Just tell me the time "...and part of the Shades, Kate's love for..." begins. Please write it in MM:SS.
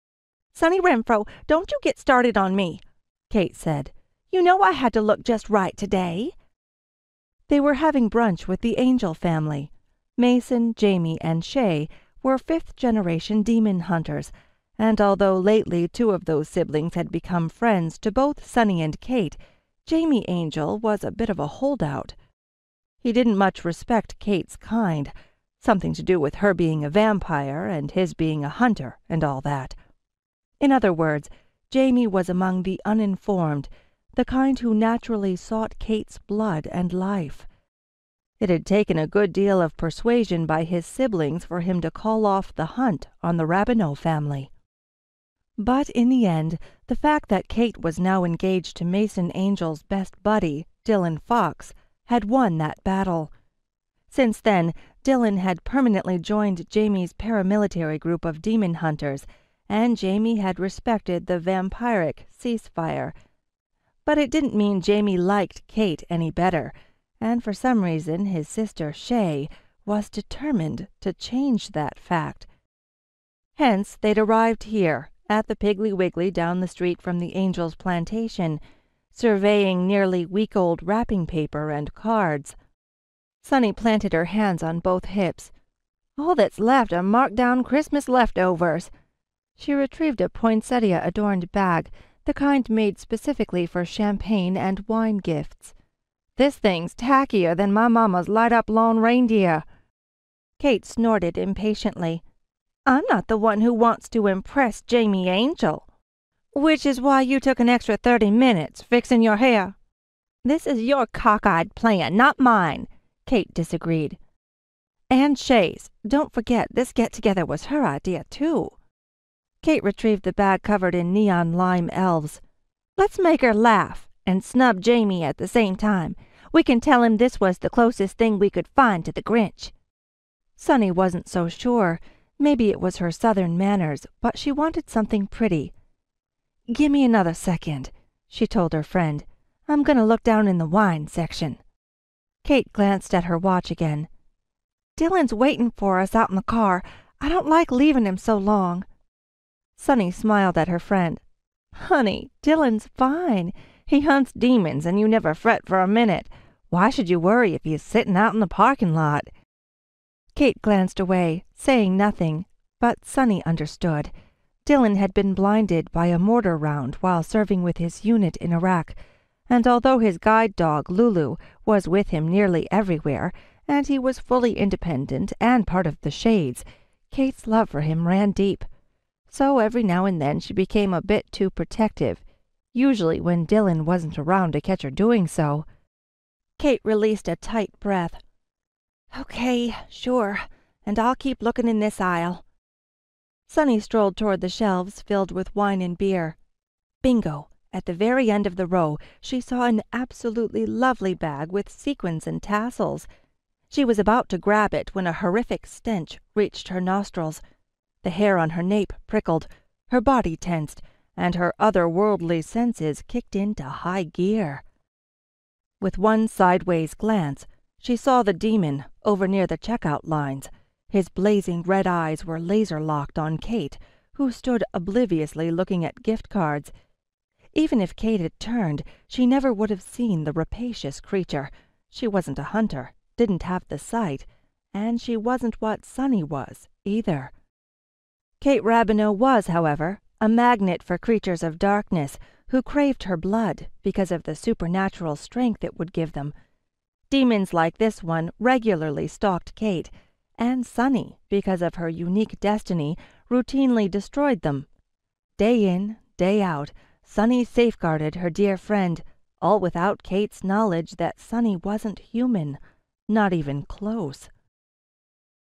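02:55.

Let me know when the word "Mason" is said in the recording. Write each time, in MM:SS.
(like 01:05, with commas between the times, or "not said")
00:10, 00:48.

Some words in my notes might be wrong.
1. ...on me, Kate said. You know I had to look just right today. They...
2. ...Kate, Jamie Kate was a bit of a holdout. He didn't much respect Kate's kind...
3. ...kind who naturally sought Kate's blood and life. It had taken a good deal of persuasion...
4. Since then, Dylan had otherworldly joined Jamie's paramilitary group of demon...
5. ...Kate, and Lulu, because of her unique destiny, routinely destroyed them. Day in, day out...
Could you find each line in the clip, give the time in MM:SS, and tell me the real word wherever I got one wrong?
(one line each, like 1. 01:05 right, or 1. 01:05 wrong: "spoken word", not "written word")
1. 00:02 right
2. 00:18 wrong: "Angel", not "Kate"
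3. 00:34 right
4. 00:54 wrong: "permanently", not "otherworldly"
5. 04:09 wrong: "Sonny", not "Lulu".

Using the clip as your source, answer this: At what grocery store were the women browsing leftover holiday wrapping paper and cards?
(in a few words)
Piggly Wiggly.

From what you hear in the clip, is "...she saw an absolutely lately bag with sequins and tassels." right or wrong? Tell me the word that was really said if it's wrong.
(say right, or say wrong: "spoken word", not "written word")
wrong: "lovely", not "lately".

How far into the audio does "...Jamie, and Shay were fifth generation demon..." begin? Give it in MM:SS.
00:10.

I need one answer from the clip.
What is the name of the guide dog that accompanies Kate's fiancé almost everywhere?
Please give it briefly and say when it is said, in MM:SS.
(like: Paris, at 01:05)
Lulu, at 02:50.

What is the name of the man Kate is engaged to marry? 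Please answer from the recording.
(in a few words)
Dylan Fox.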